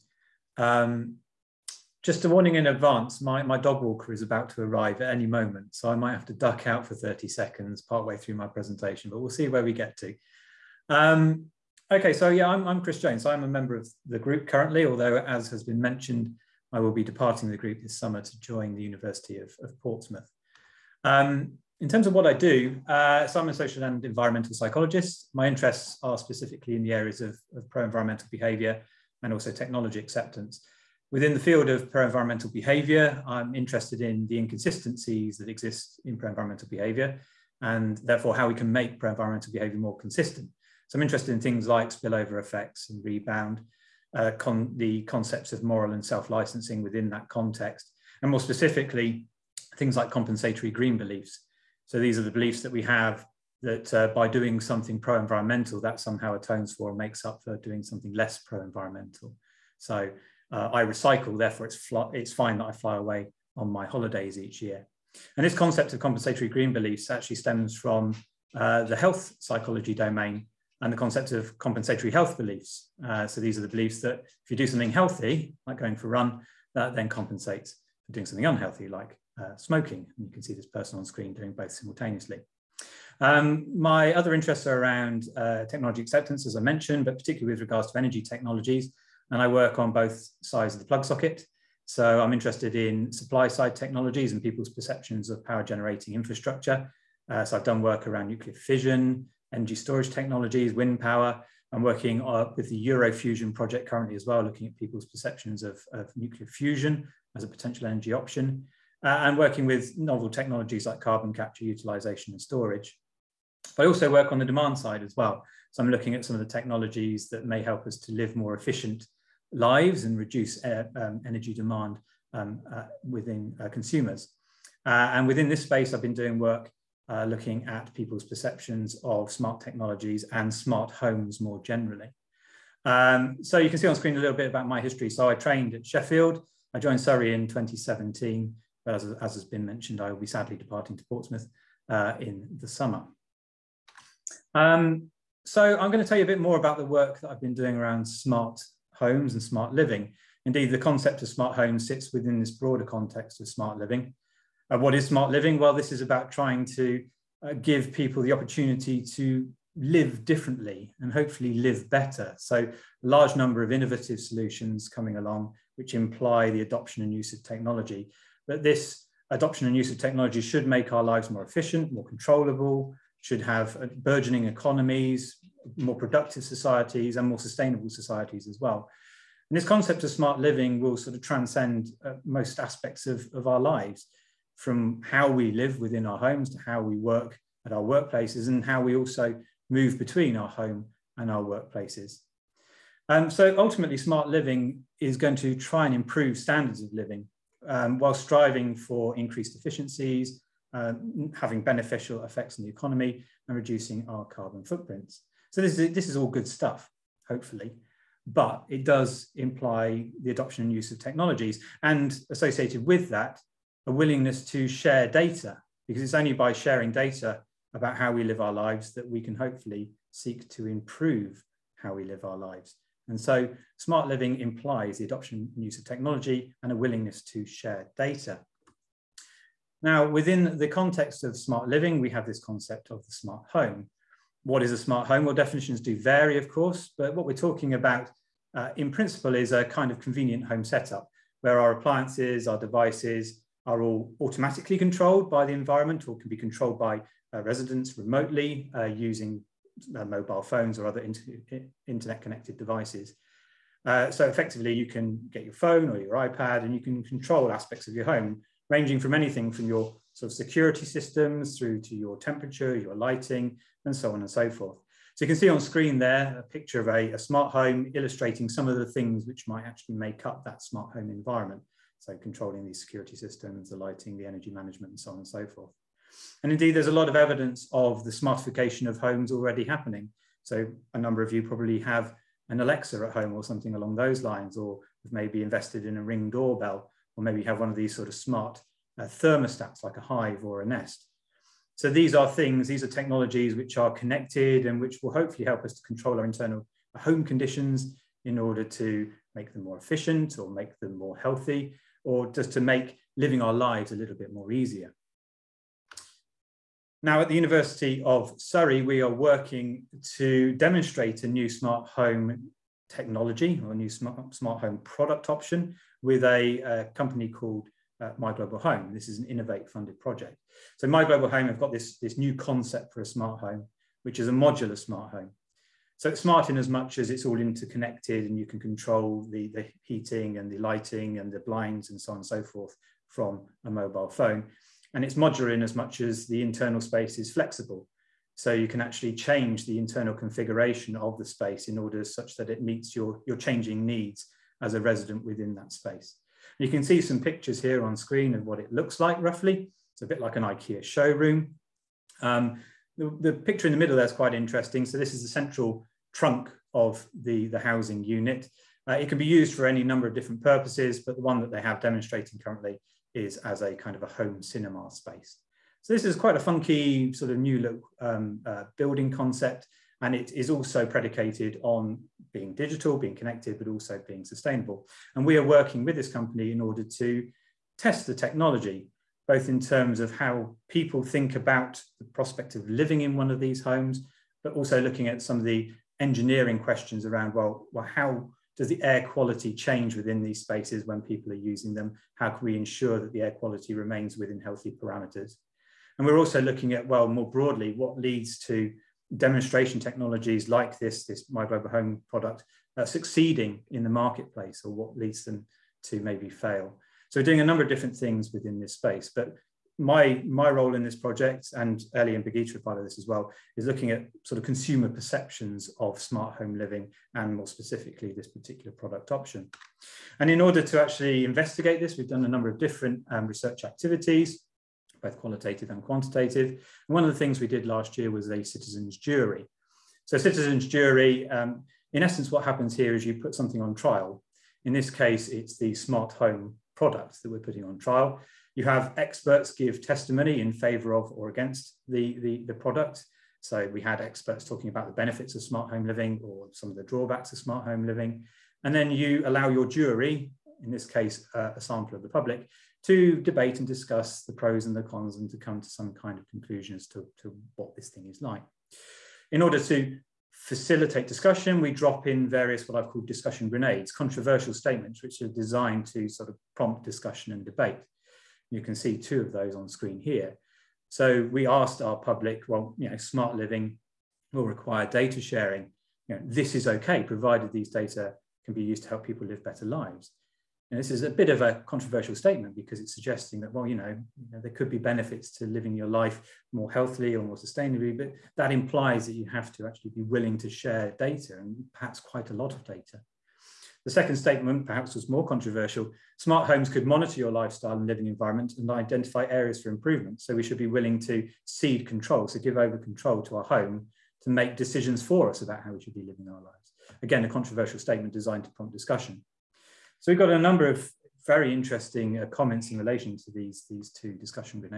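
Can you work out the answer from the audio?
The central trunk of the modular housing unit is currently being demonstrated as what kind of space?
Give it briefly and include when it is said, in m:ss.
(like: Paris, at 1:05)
Home cinema, at 6:04.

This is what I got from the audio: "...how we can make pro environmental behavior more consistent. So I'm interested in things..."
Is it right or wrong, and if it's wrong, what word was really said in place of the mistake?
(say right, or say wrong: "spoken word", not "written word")
right.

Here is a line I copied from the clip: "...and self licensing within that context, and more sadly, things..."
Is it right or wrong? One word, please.
wrong.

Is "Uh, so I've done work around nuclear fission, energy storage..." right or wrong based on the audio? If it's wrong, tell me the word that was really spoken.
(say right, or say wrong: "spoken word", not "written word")
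right.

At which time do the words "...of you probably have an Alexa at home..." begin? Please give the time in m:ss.
4:41.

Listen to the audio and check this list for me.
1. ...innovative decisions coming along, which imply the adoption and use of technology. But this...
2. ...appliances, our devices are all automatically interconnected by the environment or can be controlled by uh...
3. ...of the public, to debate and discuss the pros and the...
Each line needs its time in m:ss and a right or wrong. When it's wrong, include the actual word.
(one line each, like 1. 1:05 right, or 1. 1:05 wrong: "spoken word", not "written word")
1. 2:43 wrong: "solutions", not "decisions"
2. 4:01 wrong: "controlled", not "interconnected"
3. 7:31 right.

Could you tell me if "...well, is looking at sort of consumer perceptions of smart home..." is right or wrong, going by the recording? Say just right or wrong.
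right.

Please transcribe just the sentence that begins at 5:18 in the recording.
This is an Innovate funded project.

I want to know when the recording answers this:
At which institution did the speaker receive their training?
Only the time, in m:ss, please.
2:15.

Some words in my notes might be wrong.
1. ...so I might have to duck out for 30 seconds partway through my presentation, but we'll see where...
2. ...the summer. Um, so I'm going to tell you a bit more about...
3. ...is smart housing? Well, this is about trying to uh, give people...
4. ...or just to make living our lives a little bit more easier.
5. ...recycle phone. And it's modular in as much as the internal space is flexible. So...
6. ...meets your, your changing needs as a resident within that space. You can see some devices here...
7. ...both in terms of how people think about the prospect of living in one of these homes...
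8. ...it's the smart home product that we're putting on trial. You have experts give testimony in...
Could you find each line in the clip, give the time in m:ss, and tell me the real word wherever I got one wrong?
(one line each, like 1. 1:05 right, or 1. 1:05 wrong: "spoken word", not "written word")
1. 0:05 right
2. 2:22 right
3. 2:34 wrong: "living", not "housing"
4. 5:02 right
5. 5:33 wrong: "mobile", not "recycle"
6. 5:42 wrong: "pictures", not "devices"
7. 6:19 right
8. 7:15 right.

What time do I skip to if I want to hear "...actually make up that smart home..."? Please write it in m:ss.
4:29.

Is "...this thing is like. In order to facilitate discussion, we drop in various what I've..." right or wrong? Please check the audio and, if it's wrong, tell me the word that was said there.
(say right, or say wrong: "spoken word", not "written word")
right.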